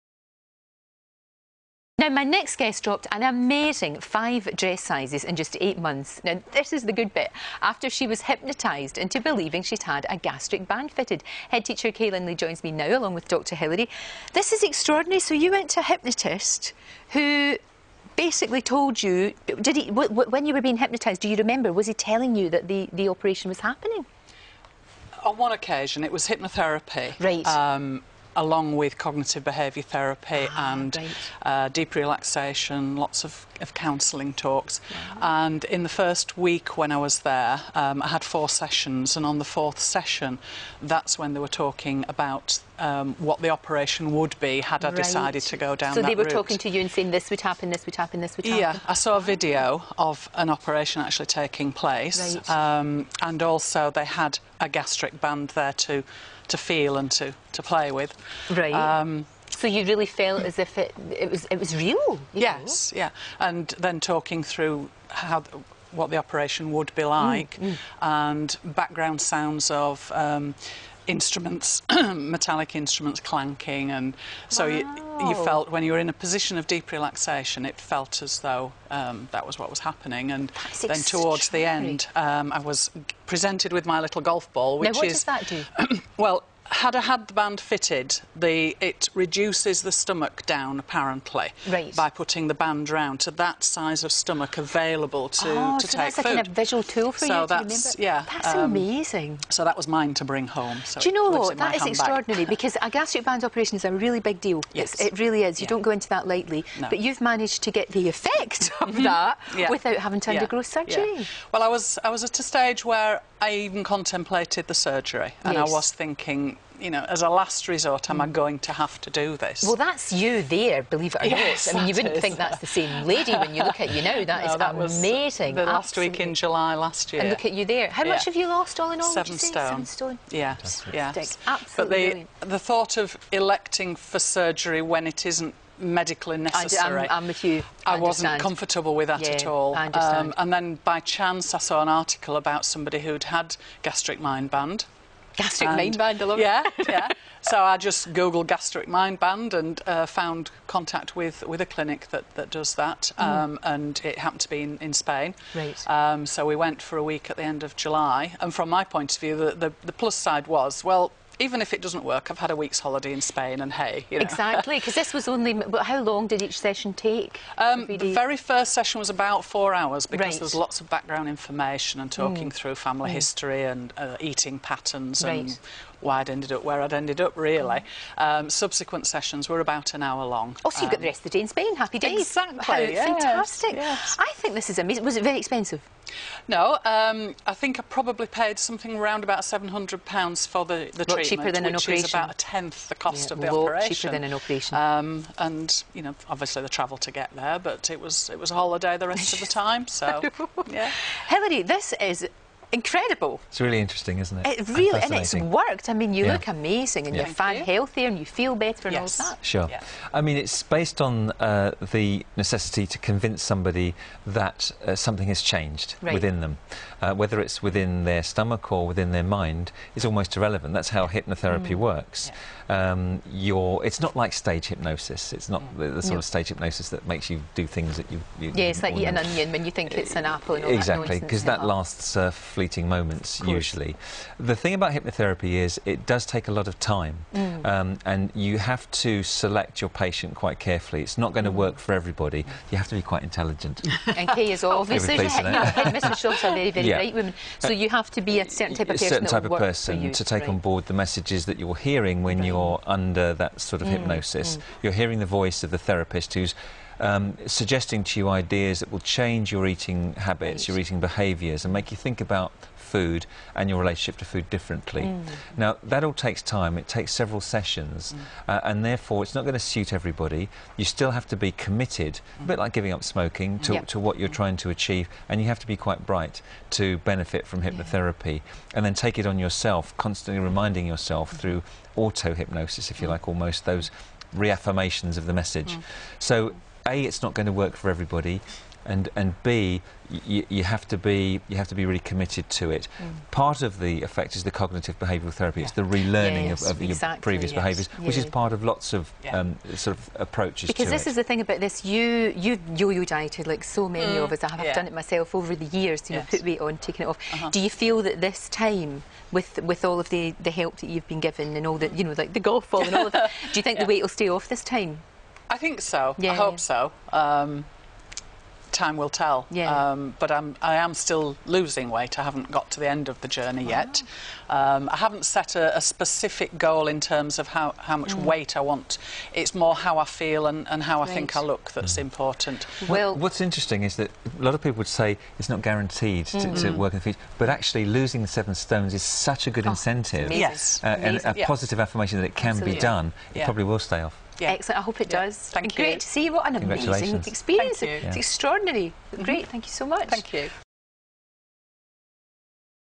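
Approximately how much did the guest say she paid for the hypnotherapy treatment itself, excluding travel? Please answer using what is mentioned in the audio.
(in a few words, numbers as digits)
£700.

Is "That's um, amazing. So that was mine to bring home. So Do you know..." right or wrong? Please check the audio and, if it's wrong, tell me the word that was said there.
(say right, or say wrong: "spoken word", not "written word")
right.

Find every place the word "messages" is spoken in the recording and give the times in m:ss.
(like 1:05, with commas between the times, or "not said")
4:10, 4:45.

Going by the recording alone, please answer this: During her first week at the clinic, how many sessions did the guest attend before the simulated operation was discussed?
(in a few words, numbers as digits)
4.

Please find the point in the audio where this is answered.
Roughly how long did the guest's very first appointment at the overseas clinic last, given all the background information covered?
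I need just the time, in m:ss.
2:49.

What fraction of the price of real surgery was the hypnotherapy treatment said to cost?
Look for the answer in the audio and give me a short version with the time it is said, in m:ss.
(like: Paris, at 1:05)
A tenth, at 3:12.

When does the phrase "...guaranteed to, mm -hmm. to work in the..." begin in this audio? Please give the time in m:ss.
5:35.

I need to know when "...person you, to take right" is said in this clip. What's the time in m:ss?
4:09.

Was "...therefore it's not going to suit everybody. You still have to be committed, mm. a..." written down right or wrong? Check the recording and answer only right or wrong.
right.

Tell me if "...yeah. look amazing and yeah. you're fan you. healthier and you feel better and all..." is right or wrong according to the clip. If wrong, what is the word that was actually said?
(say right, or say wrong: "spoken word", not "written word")
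right.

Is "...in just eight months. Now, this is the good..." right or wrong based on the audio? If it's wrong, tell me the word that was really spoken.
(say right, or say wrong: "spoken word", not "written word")
right.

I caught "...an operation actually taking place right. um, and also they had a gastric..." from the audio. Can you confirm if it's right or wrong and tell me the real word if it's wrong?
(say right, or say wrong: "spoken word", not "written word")
right.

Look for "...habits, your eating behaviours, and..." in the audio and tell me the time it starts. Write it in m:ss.
4:20.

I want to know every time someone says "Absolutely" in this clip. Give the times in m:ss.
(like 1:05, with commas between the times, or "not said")
2:11, 5:42.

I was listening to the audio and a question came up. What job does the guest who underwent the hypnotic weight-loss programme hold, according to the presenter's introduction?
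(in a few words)
Head teacher.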